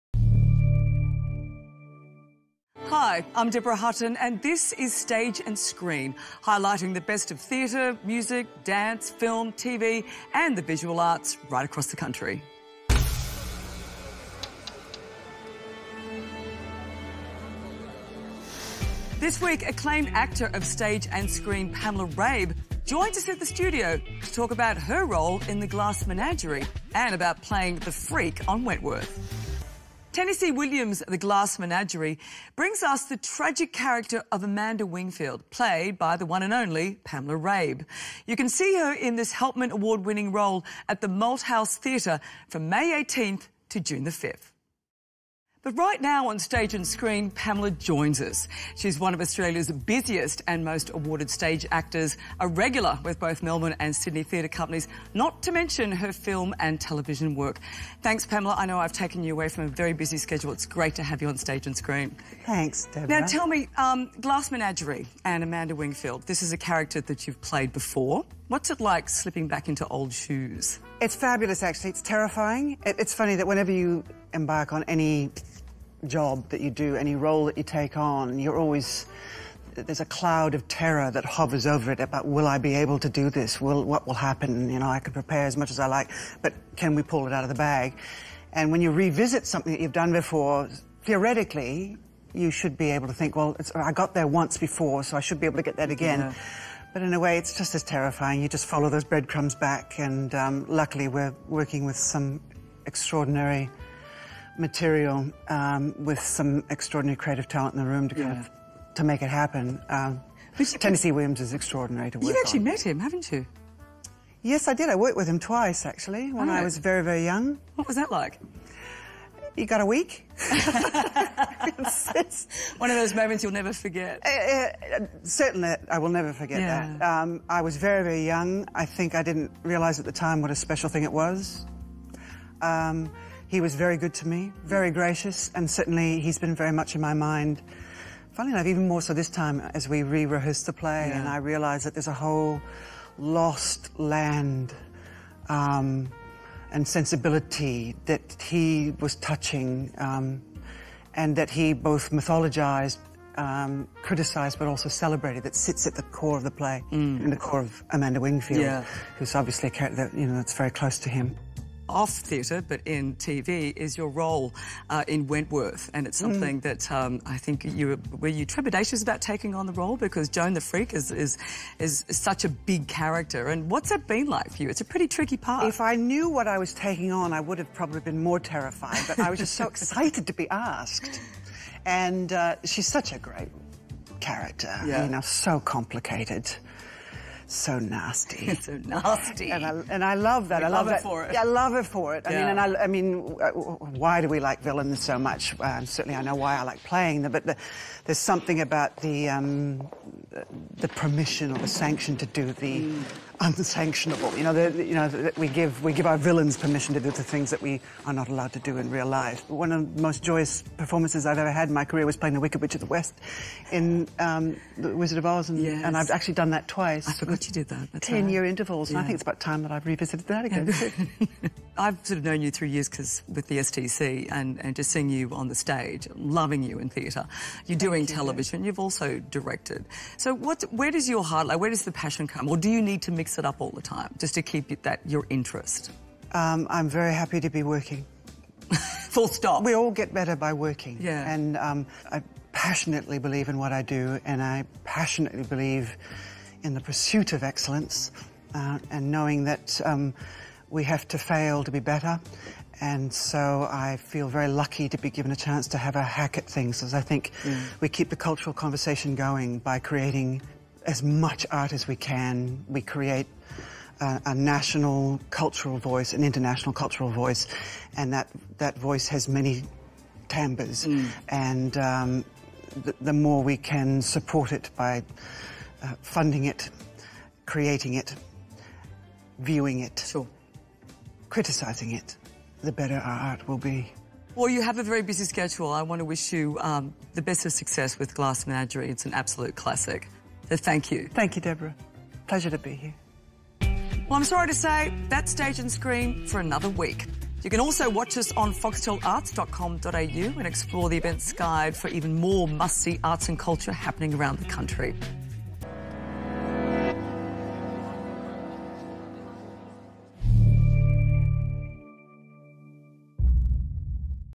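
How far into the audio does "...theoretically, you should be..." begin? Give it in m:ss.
1:31.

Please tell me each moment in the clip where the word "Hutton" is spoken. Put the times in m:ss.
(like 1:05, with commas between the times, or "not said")
0:03.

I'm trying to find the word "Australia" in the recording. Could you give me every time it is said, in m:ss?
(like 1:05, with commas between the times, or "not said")
0:49.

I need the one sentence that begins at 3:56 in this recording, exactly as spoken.
Um, I'm very happy to be working.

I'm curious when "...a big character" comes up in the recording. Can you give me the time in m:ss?
2:52.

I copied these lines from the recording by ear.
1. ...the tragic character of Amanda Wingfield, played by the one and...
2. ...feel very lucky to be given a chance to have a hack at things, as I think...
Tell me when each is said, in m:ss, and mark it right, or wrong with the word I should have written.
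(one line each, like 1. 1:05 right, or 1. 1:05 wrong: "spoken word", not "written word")
1. 0:33 right
2. 4:13 right.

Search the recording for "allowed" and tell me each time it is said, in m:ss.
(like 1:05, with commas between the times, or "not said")
3:28.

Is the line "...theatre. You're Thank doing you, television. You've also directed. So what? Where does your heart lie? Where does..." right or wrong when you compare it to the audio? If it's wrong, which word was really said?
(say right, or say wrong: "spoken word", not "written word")
right.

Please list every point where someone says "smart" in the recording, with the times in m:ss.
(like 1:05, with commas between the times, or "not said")
not said.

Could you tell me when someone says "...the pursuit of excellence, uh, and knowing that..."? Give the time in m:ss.
4:06.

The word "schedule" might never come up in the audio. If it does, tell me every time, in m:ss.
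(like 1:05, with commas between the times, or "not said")
1:00, 4:45.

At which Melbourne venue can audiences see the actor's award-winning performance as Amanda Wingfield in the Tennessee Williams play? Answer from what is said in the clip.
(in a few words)
Malthouse Theatre.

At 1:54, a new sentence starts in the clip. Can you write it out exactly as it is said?
I worked with him twice, actually, when oh.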